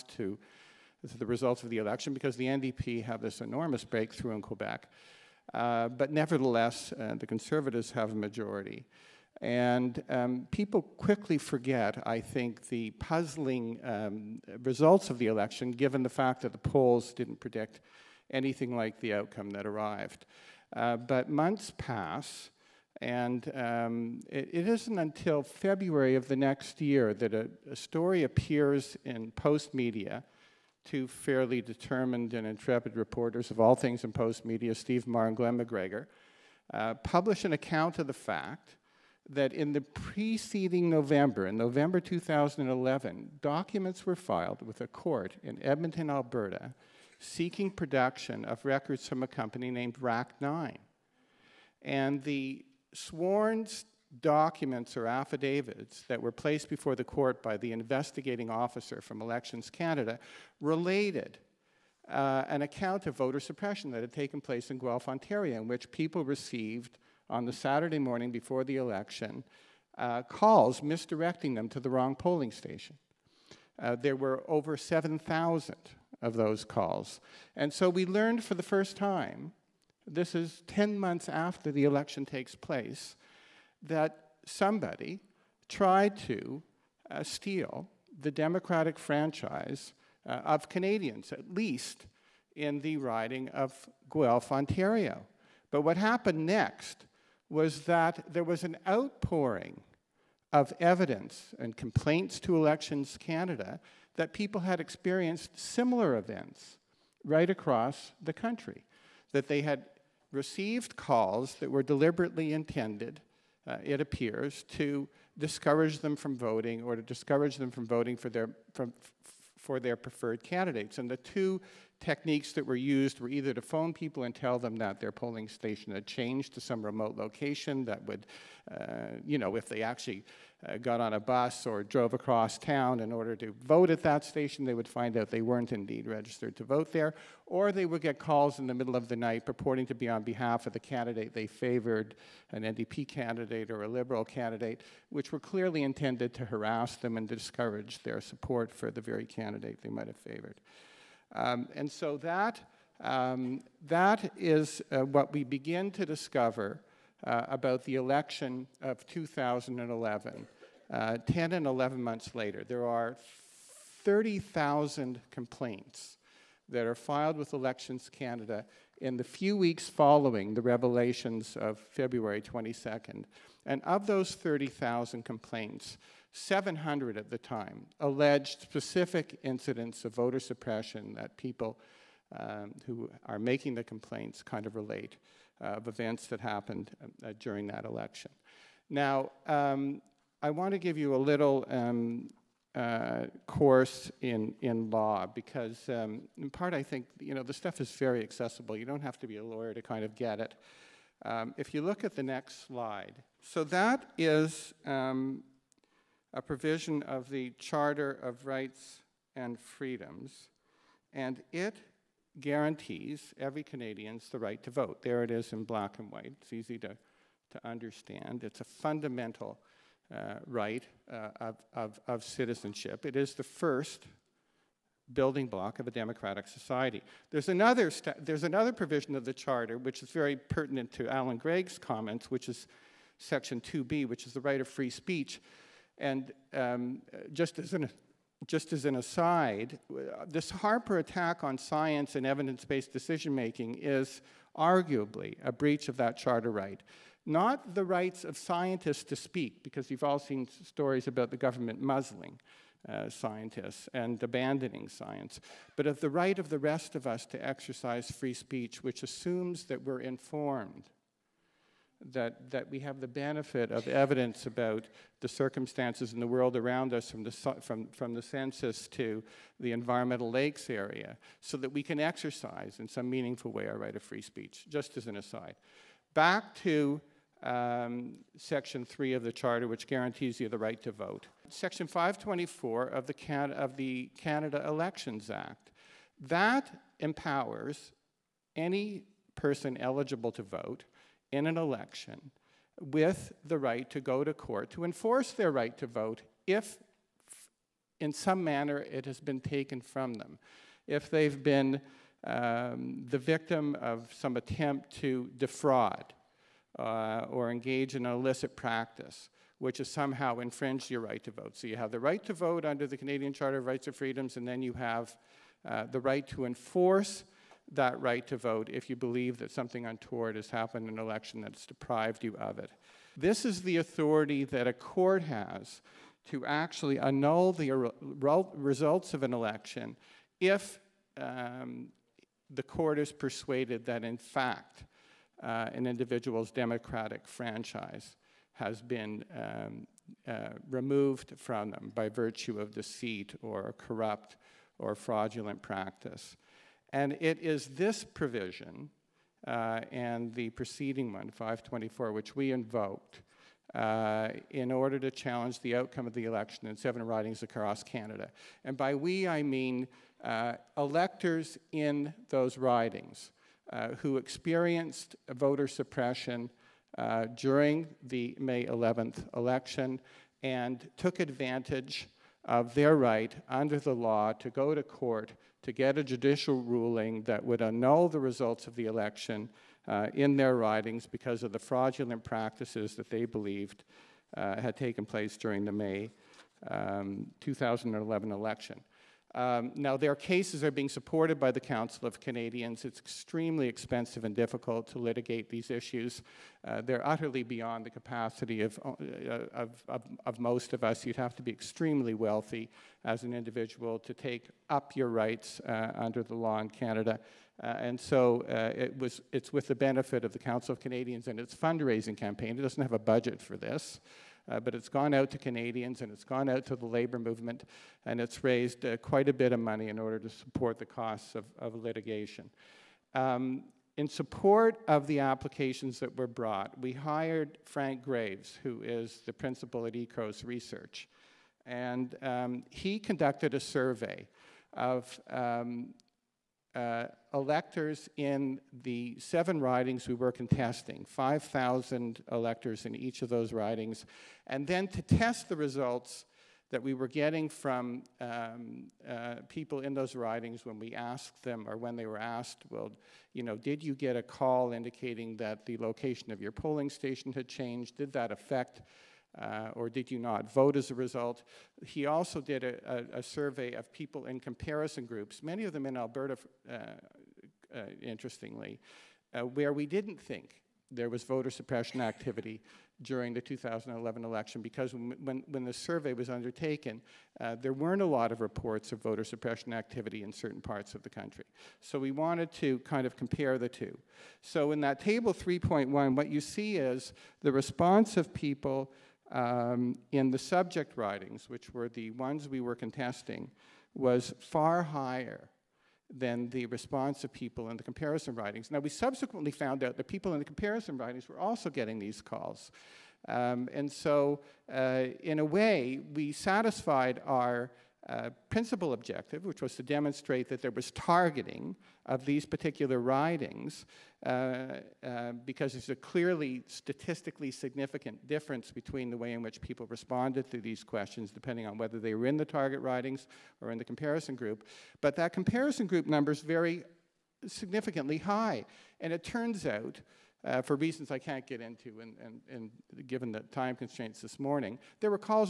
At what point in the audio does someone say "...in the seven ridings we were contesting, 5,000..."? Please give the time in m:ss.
7:18.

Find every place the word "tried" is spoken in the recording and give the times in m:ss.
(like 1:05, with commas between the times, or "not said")
1:25.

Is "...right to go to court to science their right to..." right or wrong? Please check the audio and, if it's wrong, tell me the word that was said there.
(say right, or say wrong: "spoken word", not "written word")
wrong: "enforce", not "science".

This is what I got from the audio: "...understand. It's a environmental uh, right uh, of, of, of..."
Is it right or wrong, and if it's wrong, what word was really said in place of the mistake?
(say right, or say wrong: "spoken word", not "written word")
wrong: "fundamental", not "environmental".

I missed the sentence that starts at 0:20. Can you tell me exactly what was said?
Uh, but months pass, and um, it, it isn't until February of the next year that a, a story appears in Postmedia.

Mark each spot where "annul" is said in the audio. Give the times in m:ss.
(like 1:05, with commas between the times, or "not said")
5:26, 6:17.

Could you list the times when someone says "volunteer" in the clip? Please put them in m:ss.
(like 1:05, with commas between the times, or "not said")
not said.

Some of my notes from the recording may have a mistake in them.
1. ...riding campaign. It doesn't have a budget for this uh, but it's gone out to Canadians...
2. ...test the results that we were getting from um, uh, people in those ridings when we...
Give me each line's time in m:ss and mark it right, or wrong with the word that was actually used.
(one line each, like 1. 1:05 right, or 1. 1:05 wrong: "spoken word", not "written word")
1. 6:51 wrong: "fundraising", not "riding"
2. 7:25 right.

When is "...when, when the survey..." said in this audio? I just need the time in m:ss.
7:54.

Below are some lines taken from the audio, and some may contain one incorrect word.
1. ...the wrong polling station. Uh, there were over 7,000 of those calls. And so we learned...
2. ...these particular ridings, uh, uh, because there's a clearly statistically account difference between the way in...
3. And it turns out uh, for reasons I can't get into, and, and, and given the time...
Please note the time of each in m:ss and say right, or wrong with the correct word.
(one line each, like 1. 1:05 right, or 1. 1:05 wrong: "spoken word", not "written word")
1. 1:11 right
2. 8:32 wrong: "significant", not "account"
3. 8:48 right.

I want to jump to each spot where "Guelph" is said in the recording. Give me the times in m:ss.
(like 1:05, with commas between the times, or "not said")
1:04, 1:34.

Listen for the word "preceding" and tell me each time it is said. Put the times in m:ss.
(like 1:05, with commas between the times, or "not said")
0:39, 5:50.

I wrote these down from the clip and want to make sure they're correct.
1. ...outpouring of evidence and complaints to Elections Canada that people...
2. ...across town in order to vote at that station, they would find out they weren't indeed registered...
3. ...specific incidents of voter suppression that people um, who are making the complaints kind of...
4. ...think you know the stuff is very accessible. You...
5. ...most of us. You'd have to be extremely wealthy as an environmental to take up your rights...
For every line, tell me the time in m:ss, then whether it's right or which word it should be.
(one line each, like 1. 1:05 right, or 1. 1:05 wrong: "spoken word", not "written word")
1. 1:38 right
2. 2:12 right
3. 2:58 right
4. 3:16 right
5. 6:40 wrong: "individual", not "environmental".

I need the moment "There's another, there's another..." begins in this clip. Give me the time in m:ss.
3:47.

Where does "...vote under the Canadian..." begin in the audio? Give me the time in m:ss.
5:12.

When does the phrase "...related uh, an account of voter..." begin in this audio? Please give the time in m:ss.
1:00.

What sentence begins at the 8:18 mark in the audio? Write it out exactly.
Now, we subsequently found out that people in the comparison ridings were also getting these calls.